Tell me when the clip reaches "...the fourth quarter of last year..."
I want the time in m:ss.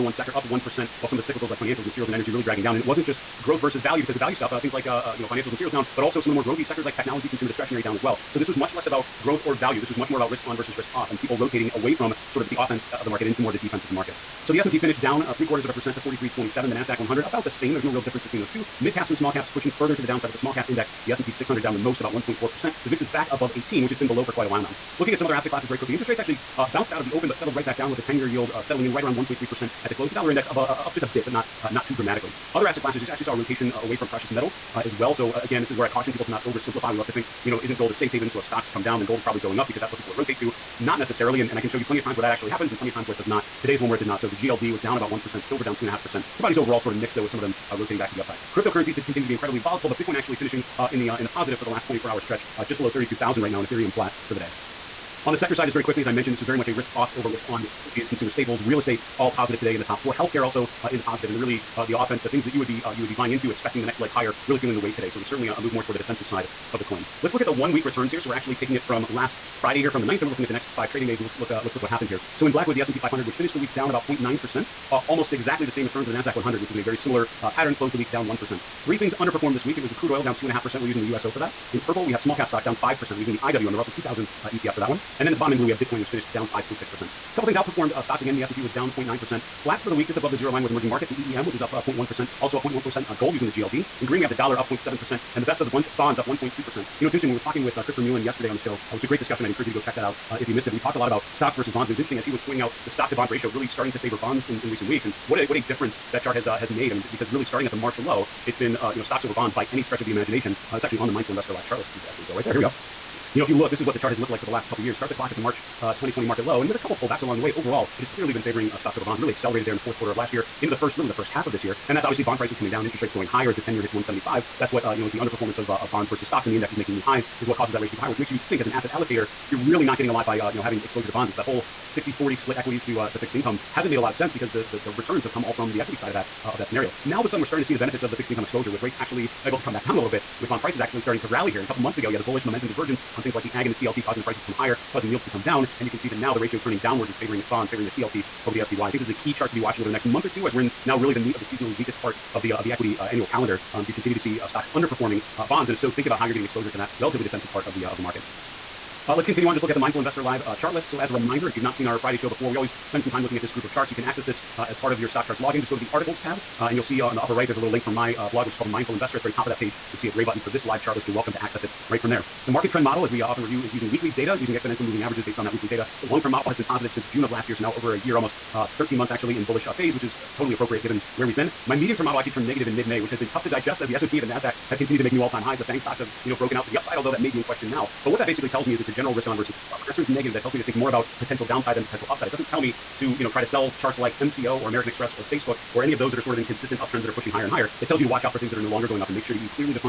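1:59.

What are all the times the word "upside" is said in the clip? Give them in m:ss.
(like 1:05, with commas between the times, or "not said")
0:48, 3:06, 3:12.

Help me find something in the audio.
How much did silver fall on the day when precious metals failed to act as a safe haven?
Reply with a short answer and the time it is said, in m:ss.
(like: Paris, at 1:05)
2.5%, at 0:45.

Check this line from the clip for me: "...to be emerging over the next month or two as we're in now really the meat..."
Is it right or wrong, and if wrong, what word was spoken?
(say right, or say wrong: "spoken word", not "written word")
wrong: "watching", not "emerging".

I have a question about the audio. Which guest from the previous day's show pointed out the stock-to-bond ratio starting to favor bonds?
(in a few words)
Christopher Mullen.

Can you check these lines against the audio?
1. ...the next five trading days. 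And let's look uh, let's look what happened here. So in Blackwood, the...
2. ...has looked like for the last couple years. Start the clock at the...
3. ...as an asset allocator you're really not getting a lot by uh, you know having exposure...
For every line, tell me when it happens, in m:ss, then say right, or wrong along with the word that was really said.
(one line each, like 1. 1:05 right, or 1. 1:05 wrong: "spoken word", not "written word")
1. 1:10 right
2. 1:54 right
3. 2:08 right.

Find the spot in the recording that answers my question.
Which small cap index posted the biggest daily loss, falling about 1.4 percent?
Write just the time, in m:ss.
0:21.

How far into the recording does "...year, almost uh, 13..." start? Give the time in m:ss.
2:57.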